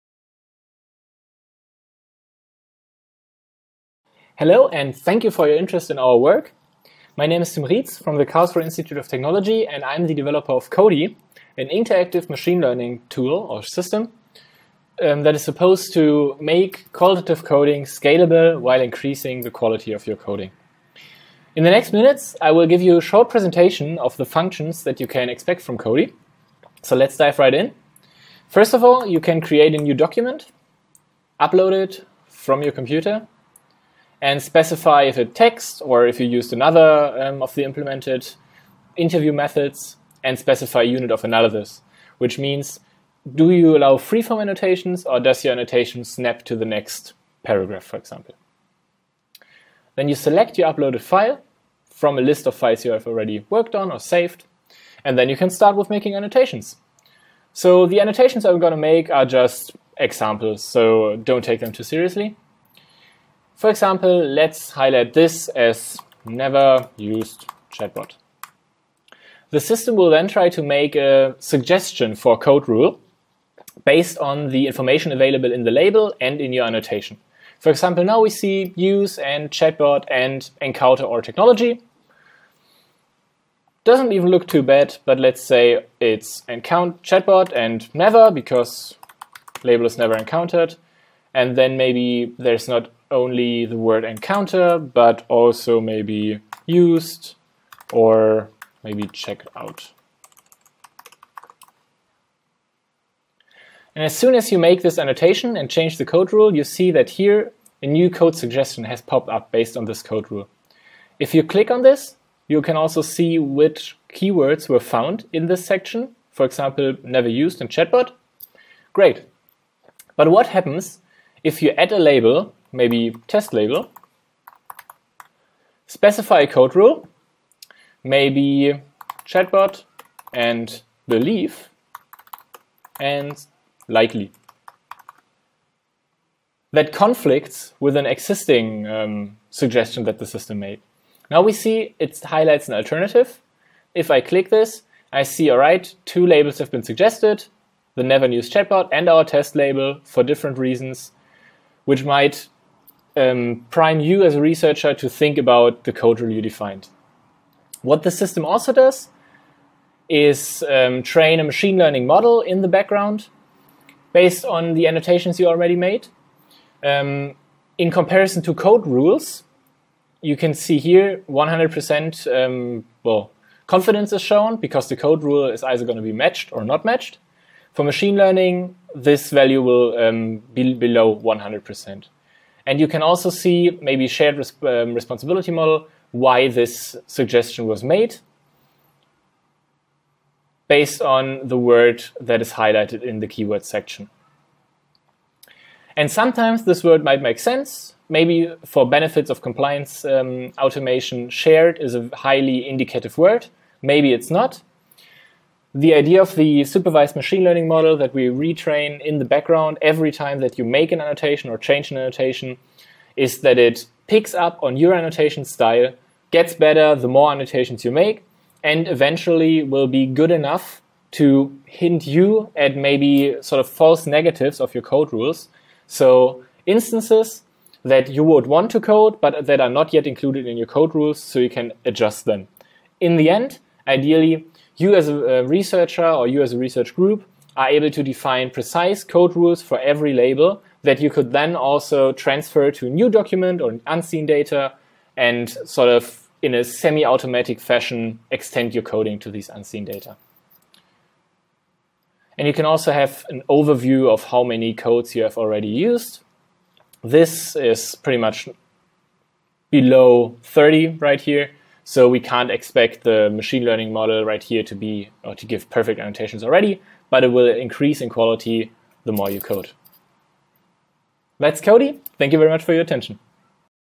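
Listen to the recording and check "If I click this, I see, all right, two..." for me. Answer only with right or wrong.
right.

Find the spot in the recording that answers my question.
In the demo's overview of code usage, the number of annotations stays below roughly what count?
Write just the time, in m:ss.
4:20.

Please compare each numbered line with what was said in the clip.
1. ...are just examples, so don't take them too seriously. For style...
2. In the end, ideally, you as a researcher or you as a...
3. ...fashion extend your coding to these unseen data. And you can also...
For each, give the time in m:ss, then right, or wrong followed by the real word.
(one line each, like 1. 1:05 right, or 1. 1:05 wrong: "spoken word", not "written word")
1. 0:59 wrong: "example", not "style"
2. 3:52 right
3. 4:07 right.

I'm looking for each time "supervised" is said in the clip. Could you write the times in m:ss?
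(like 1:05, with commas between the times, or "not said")
3:26.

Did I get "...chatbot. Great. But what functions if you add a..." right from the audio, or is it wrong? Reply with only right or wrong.
wrong.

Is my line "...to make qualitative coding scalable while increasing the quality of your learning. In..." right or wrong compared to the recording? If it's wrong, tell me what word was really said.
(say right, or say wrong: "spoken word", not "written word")
wrong: "coding", not "learning".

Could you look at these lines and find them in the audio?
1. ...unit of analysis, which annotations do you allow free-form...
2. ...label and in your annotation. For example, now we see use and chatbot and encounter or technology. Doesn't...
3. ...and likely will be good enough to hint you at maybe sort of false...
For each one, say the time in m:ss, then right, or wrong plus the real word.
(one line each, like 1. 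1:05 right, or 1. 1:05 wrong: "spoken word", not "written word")
1. 0:40 wrong: "means", not "annotations"
2. 1:15 right
3. 3:38 wrong: "eventually", not "likely".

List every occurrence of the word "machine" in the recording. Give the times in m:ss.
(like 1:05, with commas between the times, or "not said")
0:12, 2:41, 2:57, 3:27, 4:23.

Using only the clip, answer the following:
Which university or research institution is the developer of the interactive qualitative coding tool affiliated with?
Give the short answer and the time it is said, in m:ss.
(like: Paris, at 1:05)
Karlsruhe Institute of Technology, at 0:08.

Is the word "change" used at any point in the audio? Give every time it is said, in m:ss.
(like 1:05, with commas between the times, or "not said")
1:45, 3:31.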